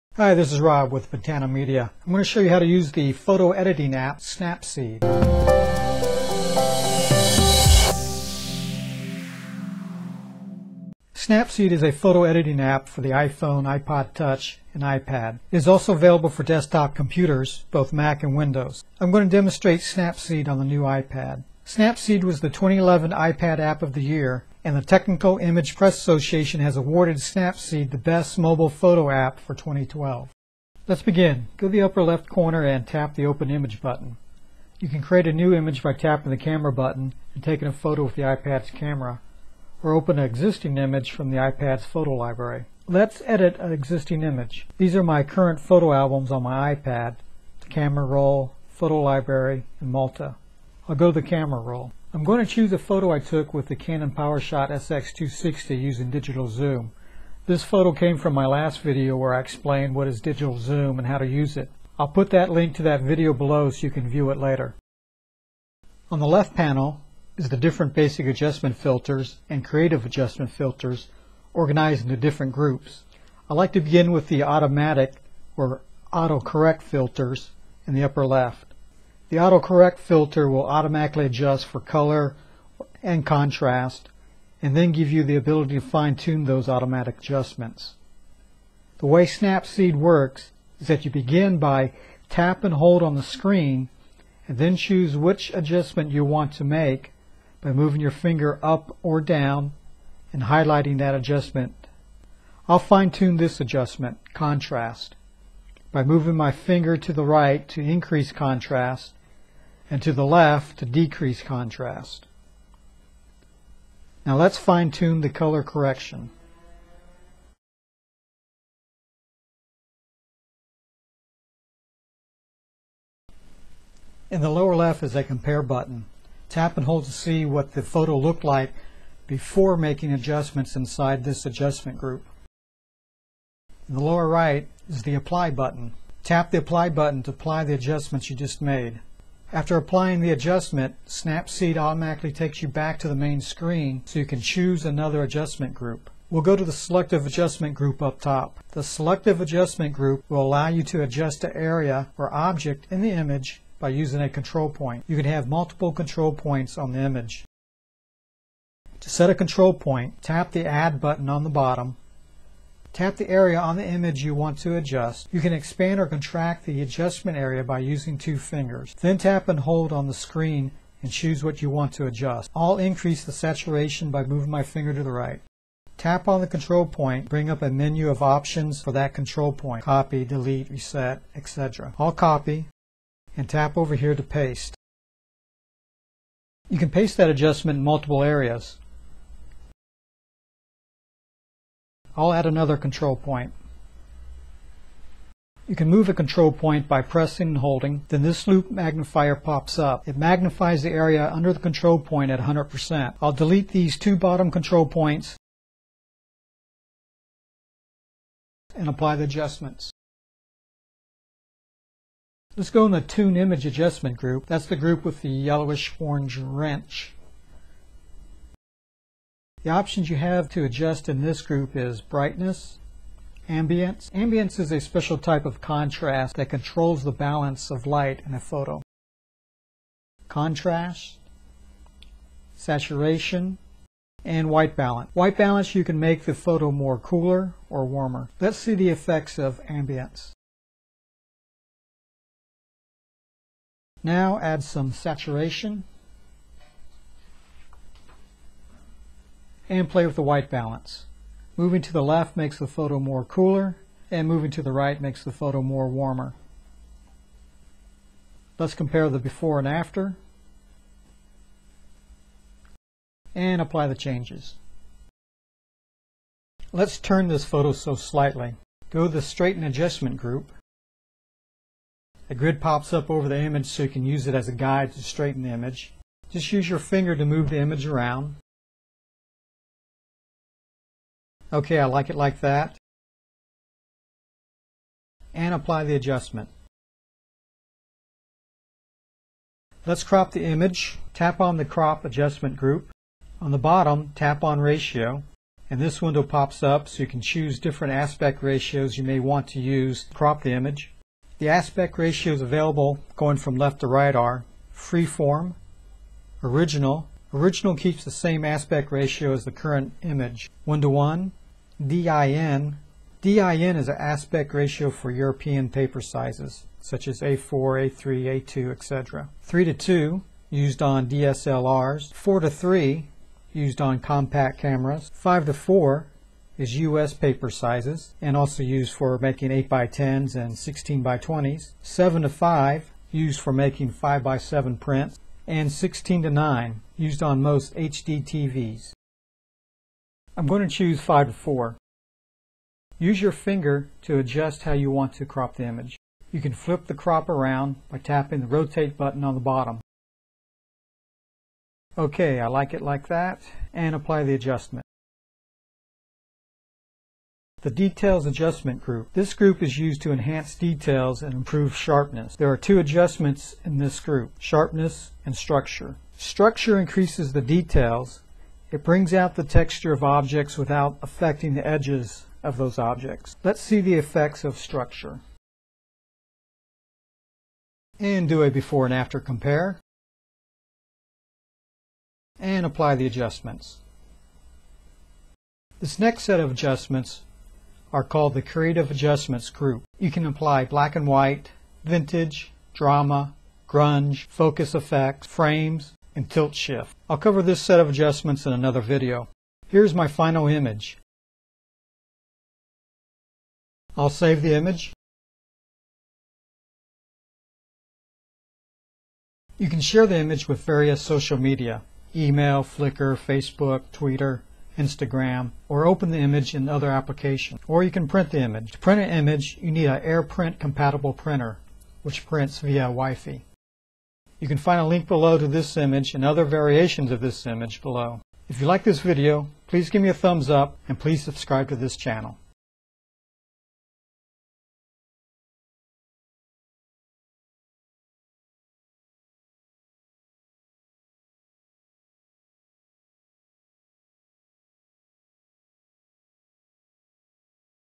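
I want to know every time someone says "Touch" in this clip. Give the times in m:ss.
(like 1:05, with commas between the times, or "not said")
0:14.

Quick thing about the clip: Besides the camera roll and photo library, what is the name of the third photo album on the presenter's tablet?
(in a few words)
Malta.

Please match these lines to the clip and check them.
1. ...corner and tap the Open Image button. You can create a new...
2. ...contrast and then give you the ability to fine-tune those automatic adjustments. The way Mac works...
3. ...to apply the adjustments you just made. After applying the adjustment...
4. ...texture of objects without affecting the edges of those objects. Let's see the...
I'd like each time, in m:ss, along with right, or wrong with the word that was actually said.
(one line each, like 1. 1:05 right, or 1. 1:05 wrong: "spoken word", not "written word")
1. 0:32 right
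2. 1:23 wrong: "Snapseed", not "Mac"
3. 2:17 right
4. 6:09 right.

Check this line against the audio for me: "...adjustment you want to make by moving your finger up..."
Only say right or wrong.
right.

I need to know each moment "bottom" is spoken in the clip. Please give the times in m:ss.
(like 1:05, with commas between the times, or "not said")
2:41, 3:24, 4:53, 5:49.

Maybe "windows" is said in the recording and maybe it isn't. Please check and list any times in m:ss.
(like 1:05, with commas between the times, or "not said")
0:18, 4:56.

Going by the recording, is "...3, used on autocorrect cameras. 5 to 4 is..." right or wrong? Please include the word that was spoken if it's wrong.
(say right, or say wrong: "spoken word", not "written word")
wrong: "compact", not "autocorrect".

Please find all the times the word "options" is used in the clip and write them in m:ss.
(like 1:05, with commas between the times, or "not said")
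2:58, 3:39.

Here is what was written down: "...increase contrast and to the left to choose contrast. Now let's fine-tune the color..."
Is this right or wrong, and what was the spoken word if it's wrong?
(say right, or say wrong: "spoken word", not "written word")
wrong: "decrease", not "choose".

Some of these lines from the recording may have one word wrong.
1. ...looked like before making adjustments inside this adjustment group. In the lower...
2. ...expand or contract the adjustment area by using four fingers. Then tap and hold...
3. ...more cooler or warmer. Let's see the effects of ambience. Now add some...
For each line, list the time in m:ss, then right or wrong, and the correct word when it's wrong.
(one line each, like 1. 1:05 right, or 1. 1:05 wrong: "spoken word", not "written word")
1. 2:08 right
2. 2:45 wrong: "two", not "four"
3. 3:56 right.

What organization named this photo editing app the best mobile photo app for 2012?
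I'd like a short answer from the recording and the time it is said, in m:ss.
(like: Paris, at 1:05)
Technical Image Press Association, at 0:24.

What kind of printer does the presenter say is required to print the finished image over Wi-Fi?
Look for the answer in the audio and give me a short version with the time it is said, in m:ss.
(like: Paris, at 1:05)
AirPrint compatible, at 7:00.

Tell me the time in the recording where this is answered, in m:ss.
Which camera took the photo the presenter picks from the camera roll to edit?
0:53.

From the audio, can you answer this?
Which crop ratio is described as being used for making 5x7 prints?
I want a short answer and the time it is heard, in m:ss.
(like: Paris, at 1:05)
7 to 5, at 5:31.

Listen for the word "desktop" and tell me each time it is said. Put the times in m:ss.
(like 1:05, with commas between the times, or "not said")
0:16.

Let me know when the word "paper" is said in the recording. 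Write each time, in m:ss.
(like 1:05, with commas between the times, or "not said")
5:15, 5:27.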